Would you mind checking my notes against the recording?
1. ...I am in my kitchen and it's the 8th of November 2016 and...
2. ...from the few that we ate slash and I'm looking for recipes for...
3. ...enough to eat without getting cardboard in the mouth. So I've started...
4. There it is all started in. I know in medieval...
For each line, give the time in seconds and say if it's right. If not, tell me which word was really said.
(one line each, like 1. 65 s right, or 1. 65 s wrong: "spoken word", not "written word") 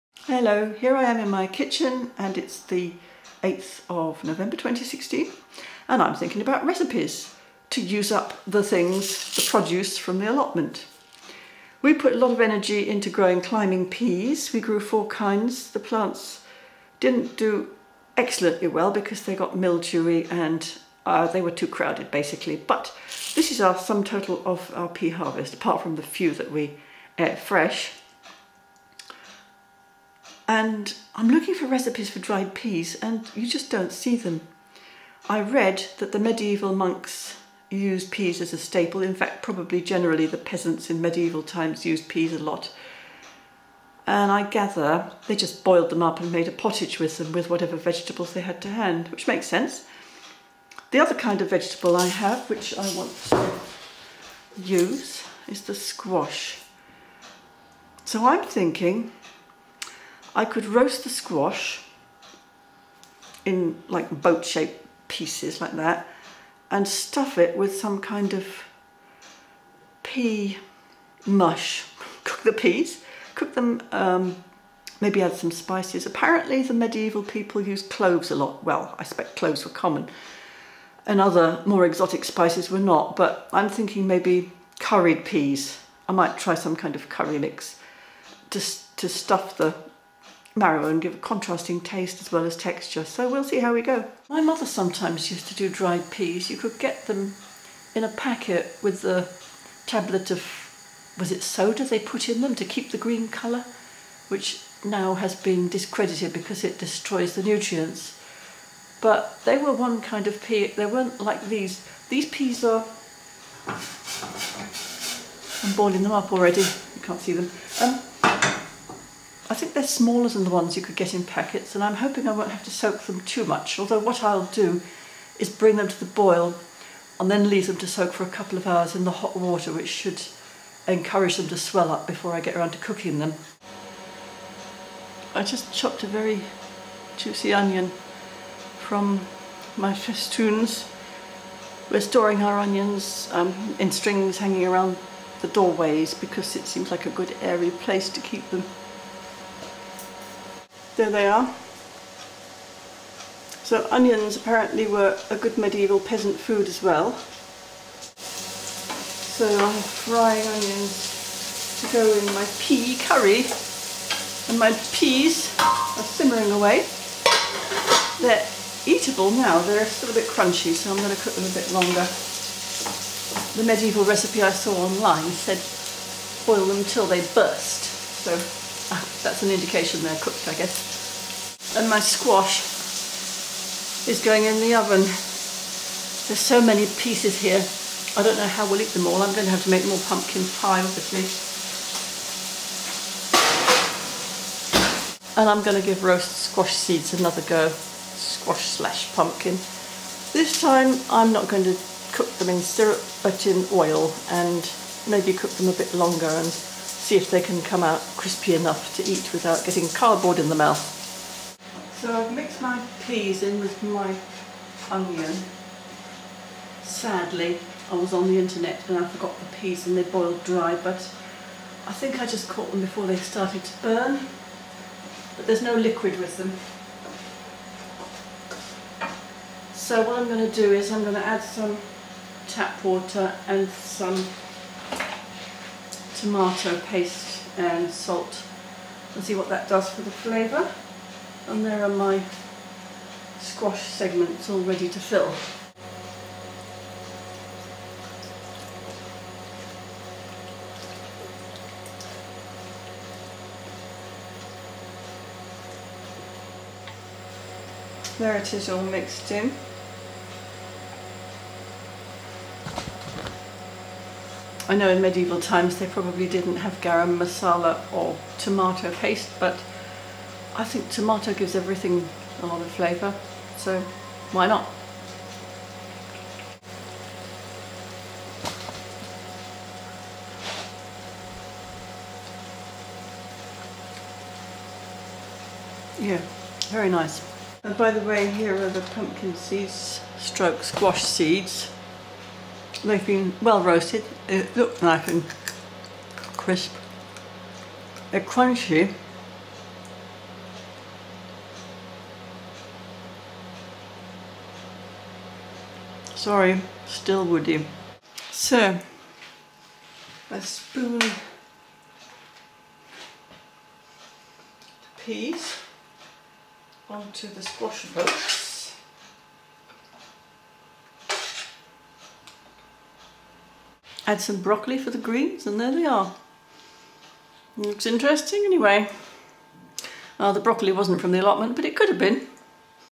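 1. 0 s right
2. 25 s wrong: "fresh", not "slash"
3. 208 s wrong: "mixed", not "started"
4. 258 s wrong: "mixed", not "started".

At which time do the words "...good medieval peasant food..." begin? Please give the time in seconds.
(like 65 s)
155 s.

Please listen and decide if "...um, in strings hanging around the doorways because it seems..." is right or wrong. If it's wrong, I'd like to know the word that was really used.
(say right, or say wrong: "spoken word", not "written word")
right.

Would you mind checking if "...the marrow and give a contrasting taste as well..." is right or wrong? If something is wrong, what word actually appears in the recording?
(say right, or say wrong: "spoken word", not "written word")
right.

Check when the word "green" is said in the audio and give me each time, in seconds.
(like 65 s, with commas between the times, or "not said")
102 s, 324 s.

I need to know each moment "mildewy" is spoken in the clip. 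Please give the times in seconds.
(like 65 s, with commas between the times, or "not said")
19 s.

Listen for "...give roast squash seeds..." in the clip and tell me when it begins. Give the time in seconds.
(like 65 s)
195 s.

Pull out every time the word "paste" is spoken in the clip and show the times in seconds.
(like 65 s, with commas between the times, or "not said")
236 s, 268 s.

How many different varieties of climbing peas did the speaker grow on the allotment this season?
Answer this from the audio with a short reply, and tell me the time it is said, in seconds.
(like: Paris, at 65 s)
4, at 14 s.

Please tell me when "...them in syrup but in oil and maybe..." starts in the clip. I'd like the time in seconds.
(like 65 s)
202 s.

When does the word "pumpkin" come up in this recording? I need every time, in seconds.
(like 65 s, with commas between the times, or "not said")
190 s, 199 s, 288 s.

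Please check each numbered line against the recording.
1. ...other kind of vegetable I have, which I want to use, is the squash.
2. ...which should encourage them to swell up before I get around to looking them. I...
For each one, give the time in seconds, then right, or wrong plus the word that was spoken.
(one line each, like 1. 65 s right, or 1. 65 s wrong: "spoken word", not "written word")
1. 50 s right
2. 129 s wrong: "cooking", not "looking".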